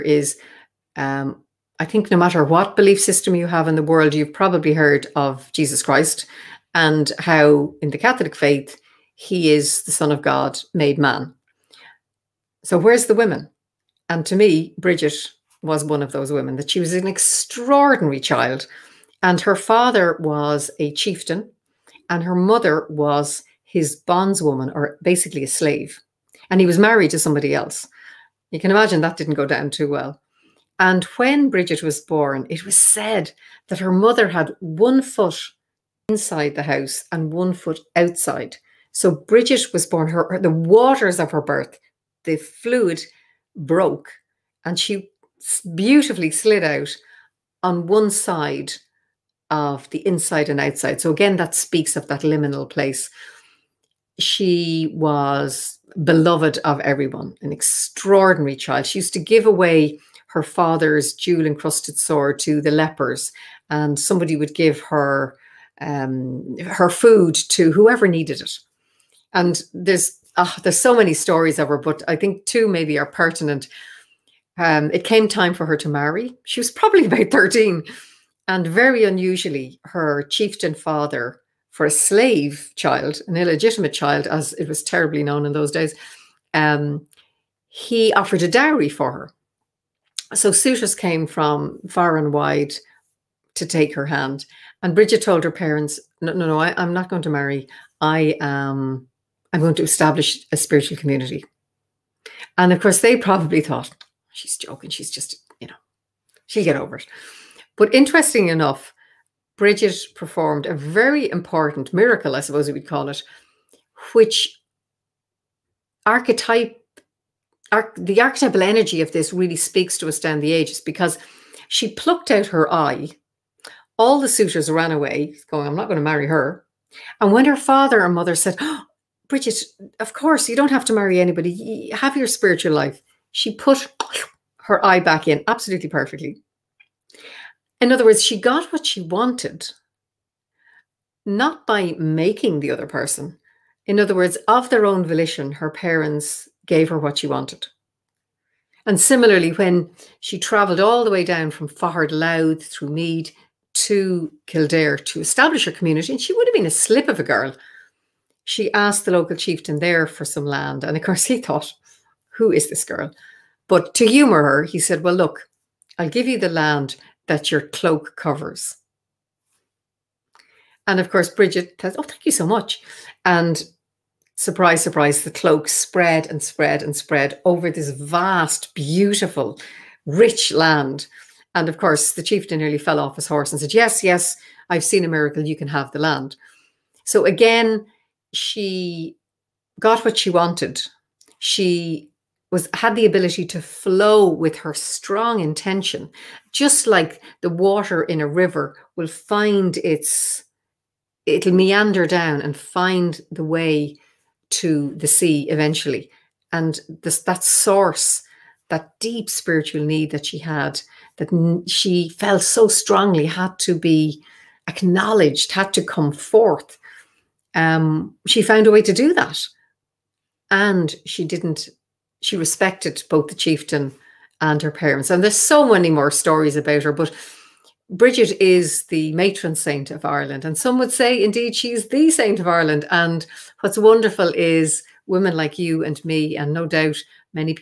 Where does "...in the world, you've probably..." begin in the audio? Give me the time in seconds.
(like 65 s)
3 s.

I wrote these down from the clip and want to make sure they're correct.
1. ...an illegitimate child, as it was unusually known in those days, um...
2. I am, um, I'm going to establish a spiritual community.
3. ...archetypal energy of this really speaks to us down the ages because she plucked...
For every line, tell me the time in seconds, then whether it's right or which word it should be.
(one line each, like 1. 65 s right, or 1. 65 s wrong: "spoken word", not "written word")
1. 83 s wrong: "terribly", not "unusually"
2. 98 s right
3. 118 s right.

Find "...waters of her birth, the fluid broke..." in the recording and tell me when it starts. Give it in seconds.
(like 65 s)
40 s.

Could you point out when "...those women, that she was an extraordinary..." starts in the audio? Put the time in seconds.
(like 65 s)
16 s.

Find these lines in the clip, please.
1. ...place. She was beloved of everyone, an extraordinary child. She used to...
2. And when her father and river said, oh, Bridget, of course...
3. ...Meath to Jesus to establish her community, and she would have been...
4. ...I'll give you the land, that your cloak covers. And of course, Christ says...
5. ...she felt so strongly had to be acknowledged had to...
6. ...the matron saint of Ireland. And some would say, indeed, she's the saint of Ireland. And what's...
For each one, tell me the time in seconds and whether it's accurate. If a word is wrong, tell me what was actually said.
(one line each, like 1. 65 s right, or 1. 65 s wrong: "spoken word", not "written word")
1. 52 s right
2. 127 s wrong: "mother", not "river"
3. 152 s wrong: "Kildare", not "Jesus"
4. 165 s wrong: "Bridget", not "Christ"
5. 211 s right
6. 228 s right.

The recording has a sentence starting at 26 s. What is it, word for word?
And he was married to somebody else.